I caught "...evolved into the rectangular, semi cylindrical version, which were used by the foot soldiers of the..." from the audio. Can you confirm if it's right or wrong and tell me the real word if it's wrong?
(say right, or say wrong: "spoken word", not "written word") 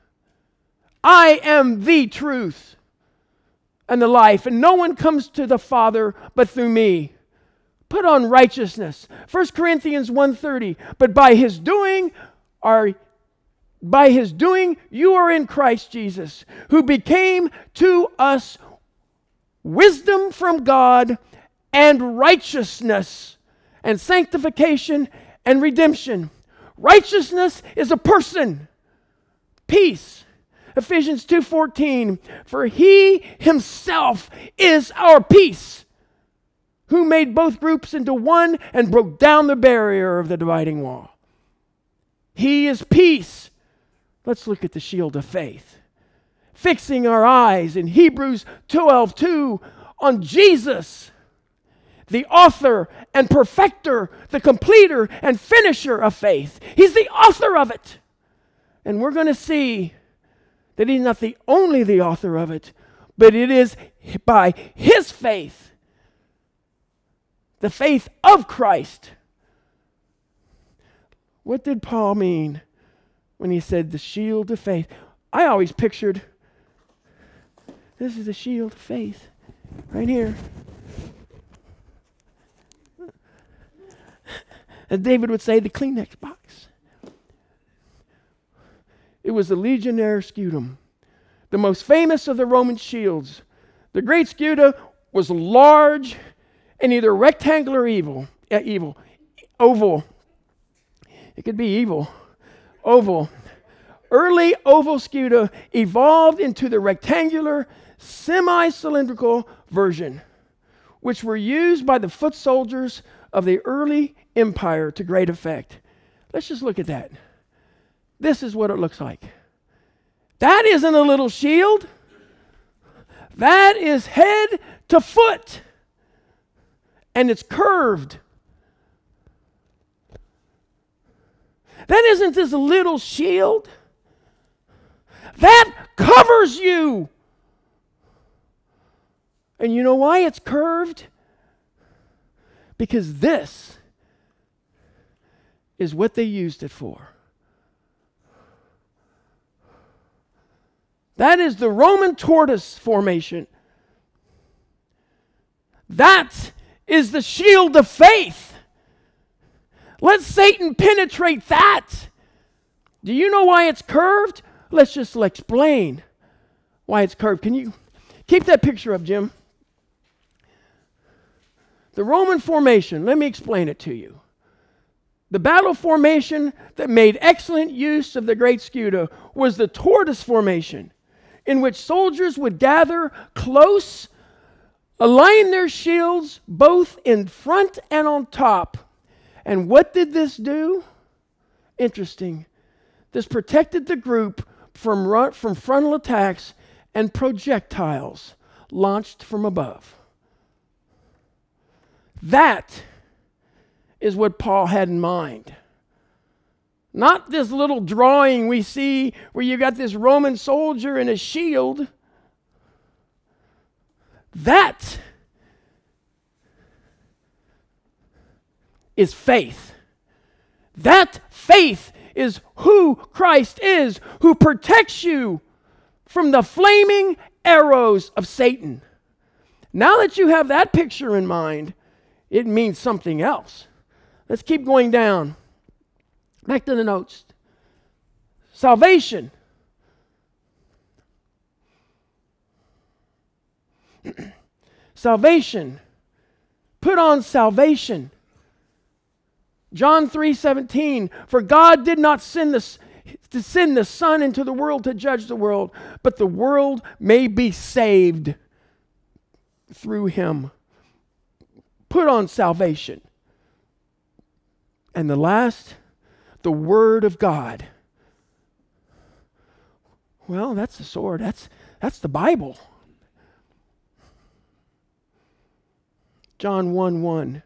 right.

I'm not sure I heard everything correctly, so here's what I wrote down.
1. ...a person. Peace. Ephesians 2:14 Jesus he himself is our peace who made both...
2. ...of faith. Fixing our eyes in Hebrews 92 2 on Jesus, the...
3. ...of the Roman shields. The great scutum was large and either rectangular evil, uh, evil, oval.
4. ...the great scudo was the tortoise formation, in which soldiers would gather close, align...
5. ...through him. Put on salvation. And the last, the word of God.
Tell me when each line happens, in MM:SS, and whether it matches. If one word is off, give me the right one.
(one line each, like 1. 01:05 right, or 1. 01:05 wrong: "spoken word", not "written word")
1. 00:27 wrong: "For", not "Jesus"
2. 00:45 wrong: "12", not "92"
3. 01:32 right
4. 02:58 right
5. 04:19 right.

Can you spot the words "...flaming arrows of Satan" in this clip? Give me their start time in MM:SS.
03:46.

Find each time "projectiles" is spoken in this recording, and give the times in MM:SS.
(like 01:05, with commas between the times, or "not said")
03:17.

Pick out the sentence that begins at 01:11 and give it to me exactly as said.
What did Paul mean when he said the shield of faith.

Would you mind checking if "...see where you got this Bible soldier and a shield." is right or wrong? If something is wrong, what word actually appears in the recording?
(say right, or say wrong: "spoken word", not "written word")
wrong: "Roman", not "Bible".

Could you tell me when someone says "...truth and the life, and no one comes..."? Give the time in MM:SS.
00:02.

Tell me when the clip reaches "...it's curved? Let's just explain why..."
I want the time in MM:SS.
02:43.